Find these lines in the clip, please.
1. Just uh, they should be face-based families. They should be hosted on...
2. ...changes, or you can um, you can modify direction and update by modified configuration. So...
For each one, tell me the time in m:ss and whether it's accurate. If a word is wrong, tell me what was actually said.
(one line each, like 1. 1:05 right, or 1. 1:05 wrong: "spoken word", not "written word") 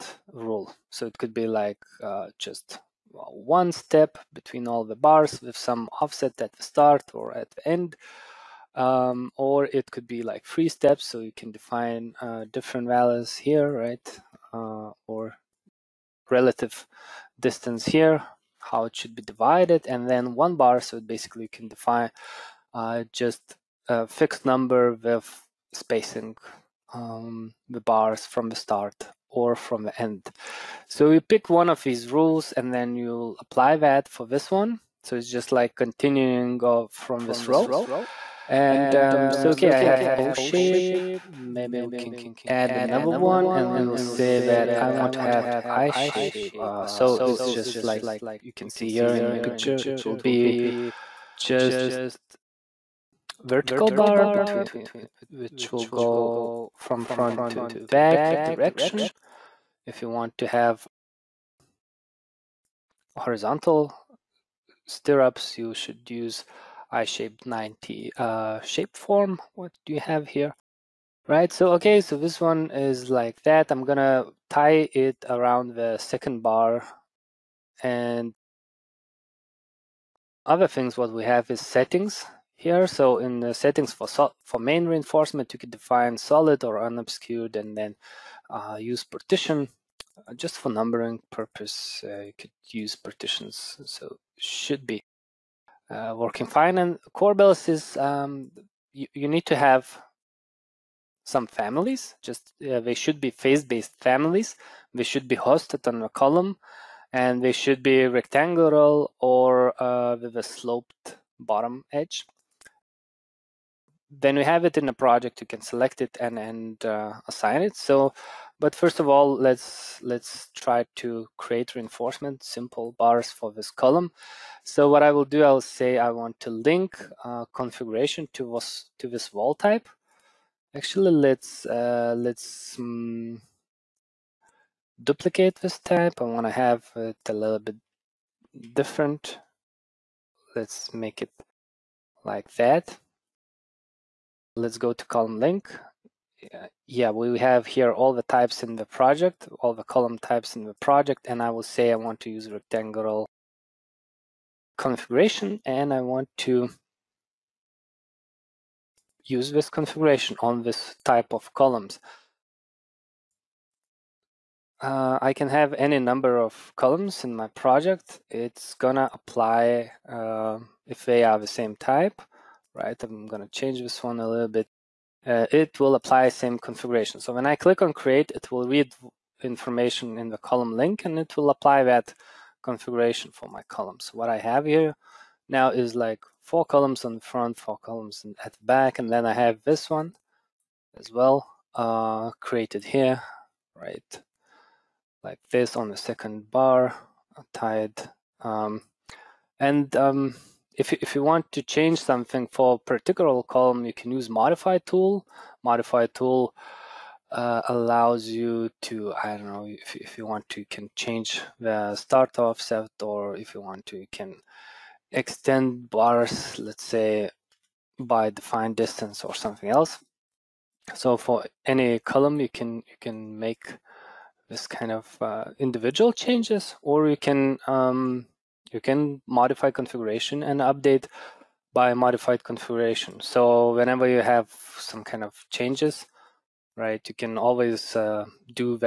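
1. 1:42 right
2. 3:46 wrong: "configuration", not "direction".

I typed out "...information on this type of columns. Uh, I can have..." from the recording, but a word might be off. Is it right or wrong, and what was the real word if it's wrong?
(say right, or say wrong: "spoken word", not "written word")
wrong: "configuration", not "information".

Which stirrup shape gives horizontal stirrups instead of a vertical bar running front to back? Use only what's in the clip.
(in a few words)
I-shaped 90.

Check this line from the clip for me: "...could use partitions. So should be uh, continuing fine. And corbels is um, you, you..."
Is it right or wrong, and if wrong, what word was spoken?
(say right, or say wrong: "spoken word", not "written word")
wrong: "working", not "continuing".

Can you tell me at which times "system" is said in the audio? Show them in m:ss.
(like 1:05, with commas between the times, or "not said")
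not said.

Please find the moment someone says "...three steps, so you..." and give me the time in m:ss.
0:10.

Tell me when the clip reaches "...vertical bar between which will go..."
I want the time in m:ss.
0:53.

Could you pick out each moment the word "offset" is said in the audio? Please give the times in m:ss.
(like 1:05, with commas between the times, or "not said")
0:06, 3:32.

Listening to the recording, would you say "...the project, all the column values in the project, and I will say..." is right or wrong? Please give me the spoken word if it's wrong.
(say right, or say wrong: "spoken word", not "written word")
wrong: "types", not "values".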